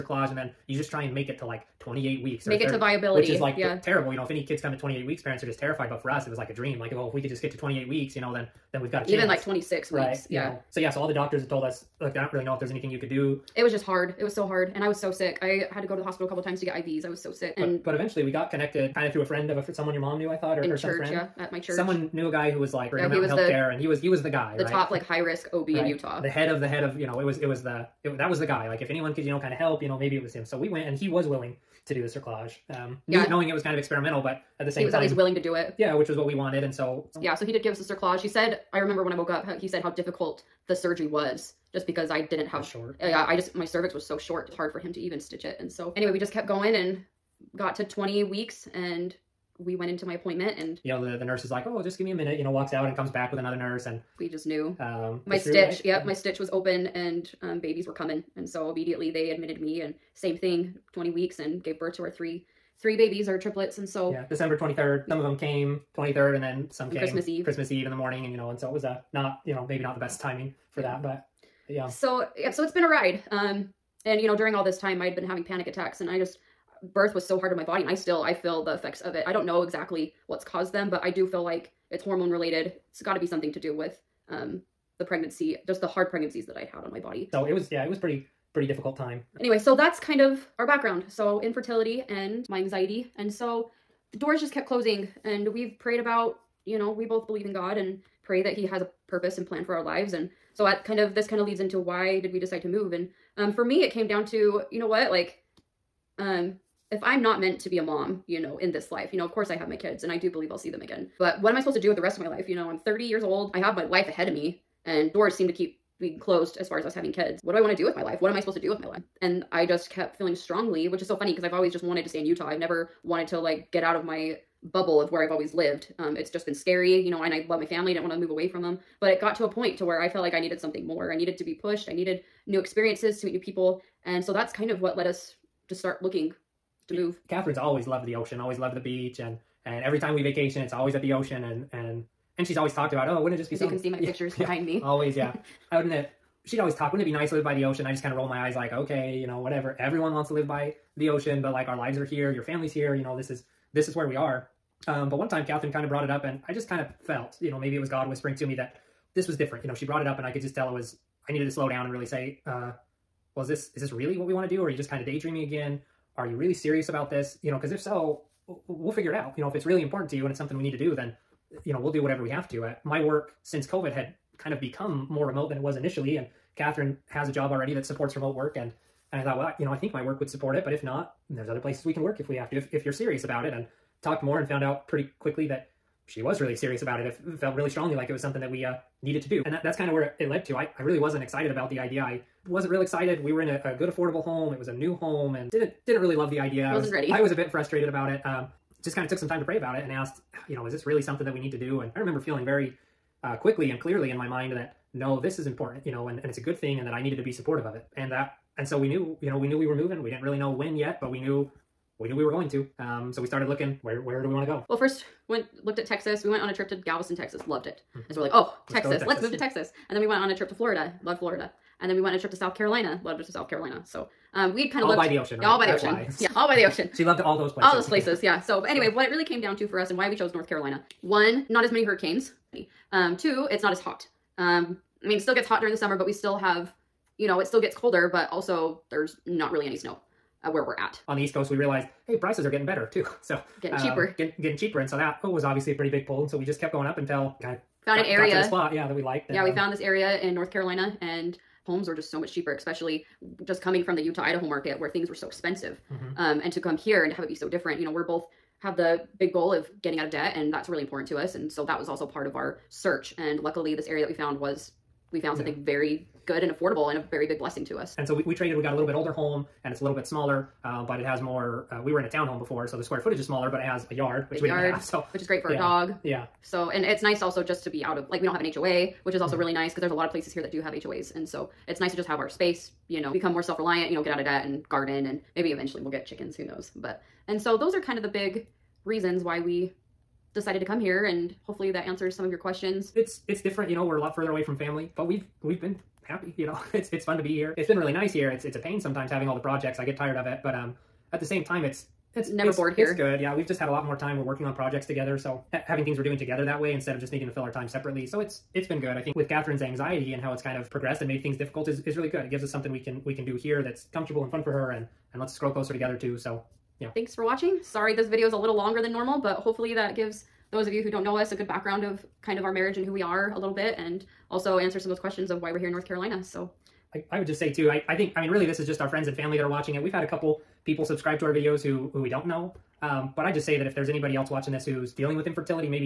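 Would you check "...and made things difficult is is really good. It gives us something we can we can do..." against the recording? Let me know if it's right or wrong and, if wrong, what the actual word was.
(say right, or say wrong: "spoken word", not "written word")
right.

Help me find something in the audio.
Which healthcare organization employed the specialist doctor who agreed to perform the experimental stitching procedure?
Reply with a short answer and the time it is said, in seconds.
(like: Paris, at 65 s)
Intermountain Healthcare, at 23 s.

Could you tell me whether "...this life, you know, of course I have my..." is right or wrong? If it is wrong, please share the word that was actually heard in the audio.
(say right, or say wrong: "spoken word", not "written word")
right.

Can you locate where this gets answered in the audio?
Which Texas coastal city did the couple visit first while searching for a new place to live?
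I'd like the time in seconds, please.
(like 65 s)
216 s.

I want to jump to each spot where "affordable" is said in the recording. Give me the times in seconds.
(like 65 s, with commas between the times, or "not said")
193 s, 266 s.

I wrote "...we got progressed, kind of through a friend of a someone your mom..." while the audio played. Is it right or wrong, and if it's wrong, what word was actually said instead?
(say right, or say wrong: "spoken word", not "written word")
wrong: "connected", not "progressed".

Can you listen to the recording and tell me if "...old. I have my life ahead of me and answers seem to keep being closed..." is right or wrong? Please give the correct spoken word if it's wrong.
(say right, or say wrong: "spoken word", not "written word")
wrong: "doors", not "answers".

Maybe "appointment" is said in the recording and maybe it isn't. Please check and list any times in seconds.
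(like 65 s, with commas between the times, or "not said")
50 s.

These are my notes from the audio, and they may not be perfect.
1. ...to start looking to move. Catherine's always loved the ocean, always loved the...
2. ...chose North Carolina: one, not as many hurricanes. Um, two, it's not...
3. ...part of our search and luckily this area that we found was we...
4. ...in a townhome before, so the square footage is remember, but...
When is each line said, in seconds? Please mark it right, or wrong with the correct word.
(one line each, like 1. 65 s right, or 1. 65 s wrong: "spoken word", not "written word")
1. 135 s right
2. 230 s right
3. 262 s right
4. 271 s wrong: "smaller", not "remember".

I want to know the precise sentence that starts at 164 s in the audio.
Or are you just kind of daydreaming again?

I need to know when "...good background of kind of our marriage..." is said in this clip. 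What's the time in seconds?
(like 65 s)
321 s.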